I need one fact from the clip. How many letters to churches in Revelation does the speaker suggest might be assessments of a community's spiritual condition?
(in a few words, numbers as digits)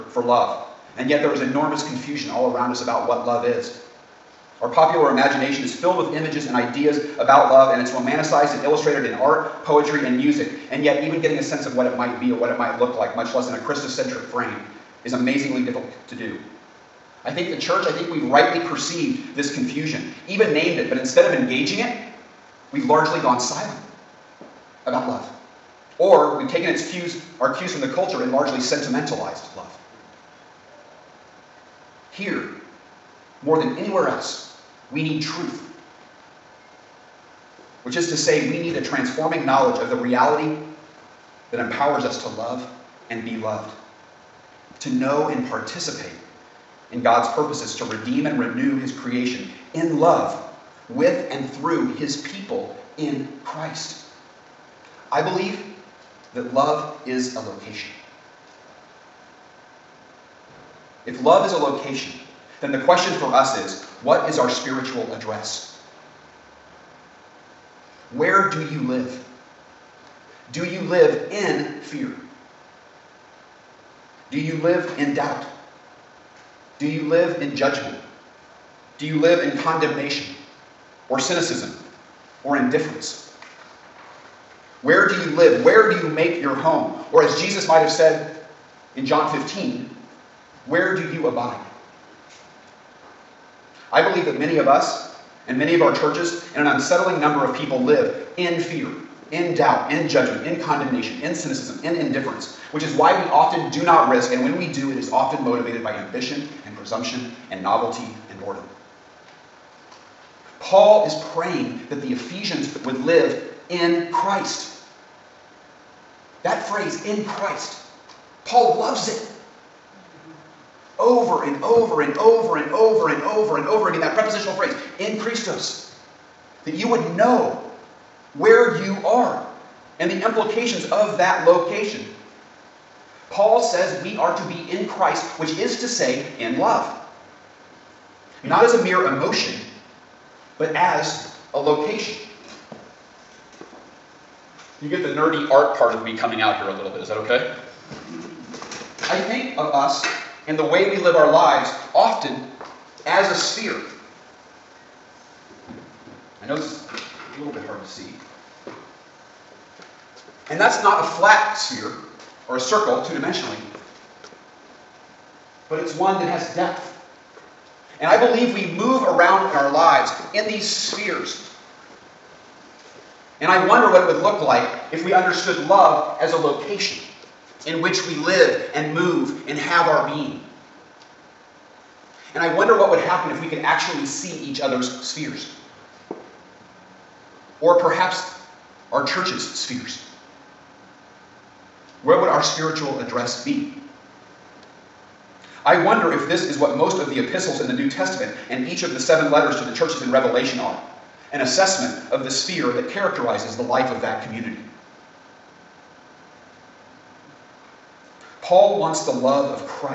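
7.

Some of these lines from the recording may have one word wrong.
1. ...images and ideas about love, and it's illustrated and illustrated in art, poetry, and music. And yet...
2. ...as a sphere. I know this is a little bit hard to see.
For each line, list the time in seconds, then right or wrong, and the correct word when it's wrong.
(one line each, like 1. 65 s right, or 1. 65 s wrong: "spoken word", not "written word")
1. 6 s wrong: "romanticized", not "illustrated"
2. 153 s right.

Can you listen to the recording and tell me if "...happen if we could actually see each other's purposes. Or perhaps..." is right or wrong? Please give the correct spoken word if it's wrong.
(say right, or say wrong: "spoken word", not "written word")
wrong: "spheres", not "purposes".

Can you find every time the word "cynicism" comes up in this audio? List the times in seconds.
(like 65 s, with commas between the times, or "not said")
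81 s, 101 s.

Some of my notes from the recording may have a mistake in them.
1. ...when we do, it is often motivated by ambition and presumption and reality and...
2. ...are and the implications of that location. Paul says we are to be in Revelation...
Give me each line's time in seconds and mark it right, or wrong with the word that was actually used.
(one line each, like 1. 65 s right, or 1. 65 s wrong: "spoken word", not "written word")
1. 104 s wrong: "novelty", not "reality"
2. 129 s wrong: "Christ", not "Revelation".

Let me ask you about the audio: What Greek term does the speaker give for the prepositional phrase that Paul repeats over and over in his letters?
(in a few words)
in Christos.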